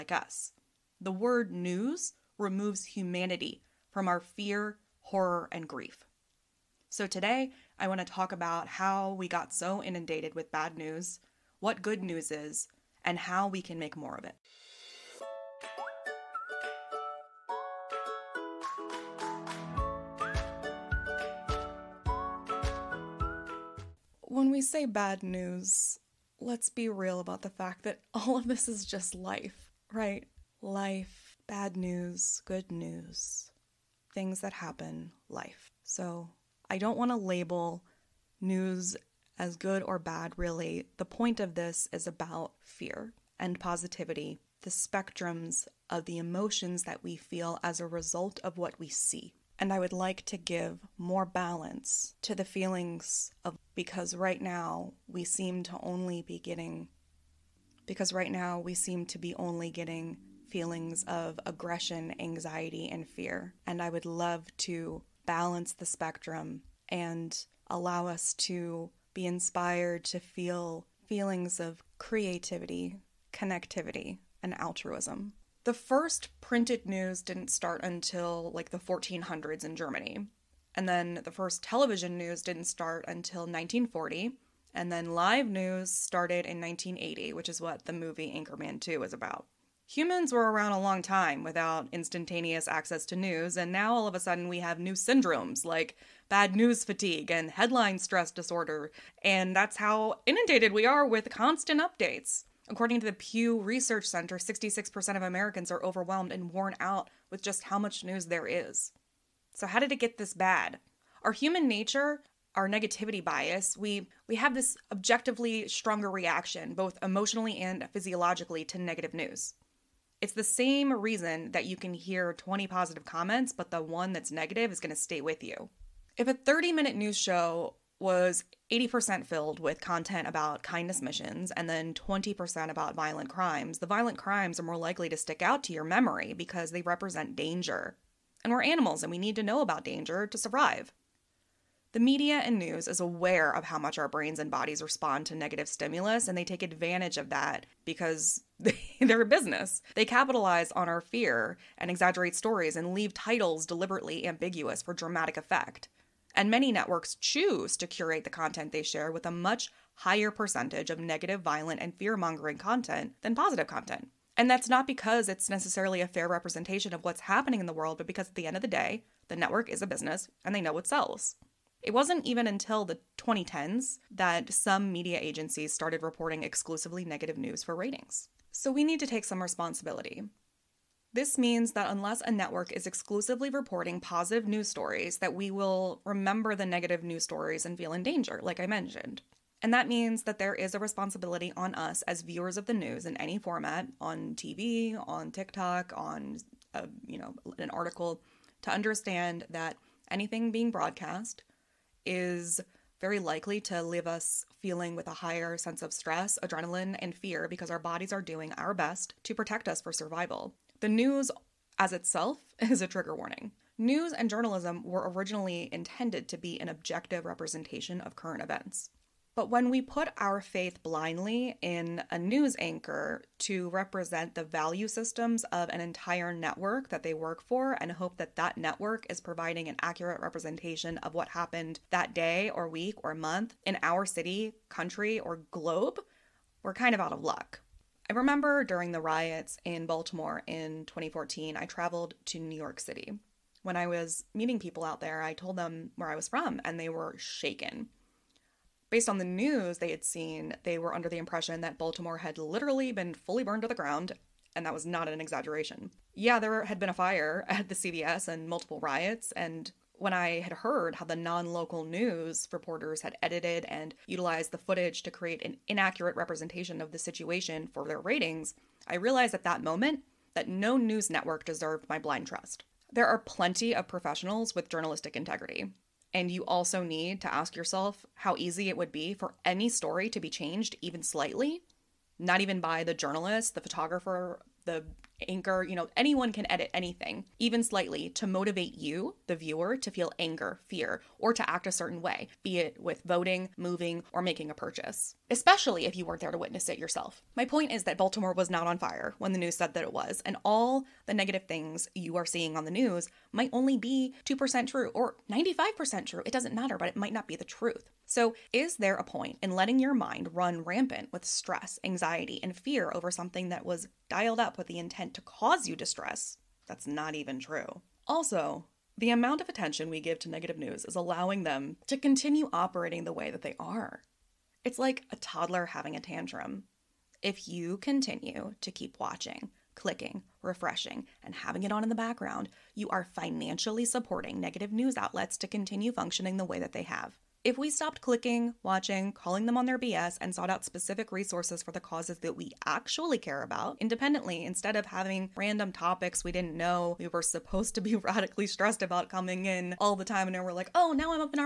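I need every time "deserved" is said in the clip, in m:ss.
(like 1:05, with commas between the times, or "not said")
4:31.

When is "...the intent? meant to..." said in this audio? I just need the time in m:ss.
5:14.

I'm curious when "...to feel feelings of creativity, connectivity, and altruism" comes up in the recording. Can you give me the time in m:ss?
1:10.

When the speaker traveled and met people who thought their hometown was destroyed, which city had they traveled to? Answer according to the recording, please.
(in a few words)
New York City.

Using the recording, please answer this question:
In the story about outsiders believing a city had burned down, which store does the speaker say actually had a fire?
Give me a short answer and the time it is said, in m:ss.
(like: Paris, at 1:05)
CVS, at 4:17.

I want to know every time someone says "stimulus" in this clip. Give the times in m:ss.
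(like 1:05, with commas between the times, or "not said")
2:25.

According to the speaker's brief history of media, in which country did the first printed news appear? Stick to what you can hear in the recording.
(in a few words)
Germany.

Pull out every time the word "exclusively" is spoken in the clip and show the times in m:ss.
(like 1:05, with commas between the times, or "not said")
2:56, 3:02.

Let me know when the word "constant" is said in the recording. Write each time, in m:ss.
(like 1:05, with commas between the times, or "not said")
1:41.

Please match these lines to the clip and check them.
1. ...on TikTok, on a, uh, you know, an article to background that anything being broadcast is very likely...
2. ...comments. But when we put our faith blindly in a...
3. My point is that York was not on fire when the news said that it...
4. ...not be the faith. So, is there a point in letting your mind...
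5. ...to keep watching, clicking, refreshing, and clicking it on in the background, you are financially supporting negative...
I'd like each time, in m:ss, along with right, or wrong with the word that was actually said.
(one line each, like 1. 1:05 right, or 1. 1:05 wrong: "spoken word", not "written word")
1. 3:15 wrong: "understand", not "background"
2. 3:38 wrong: "events", not "comments"
3. 4:57 wrong: "Baltimore", not "York"
4. 5:07 wrong: "truth", not "faith"
5. 5:28 wrong: "having", not "clicking".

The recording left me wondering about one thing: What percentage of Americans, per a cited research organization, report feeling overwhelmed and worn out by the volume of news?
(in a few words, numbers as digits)
66%.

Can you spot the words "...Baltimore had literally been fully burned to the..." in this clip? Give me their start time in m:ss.
4:11.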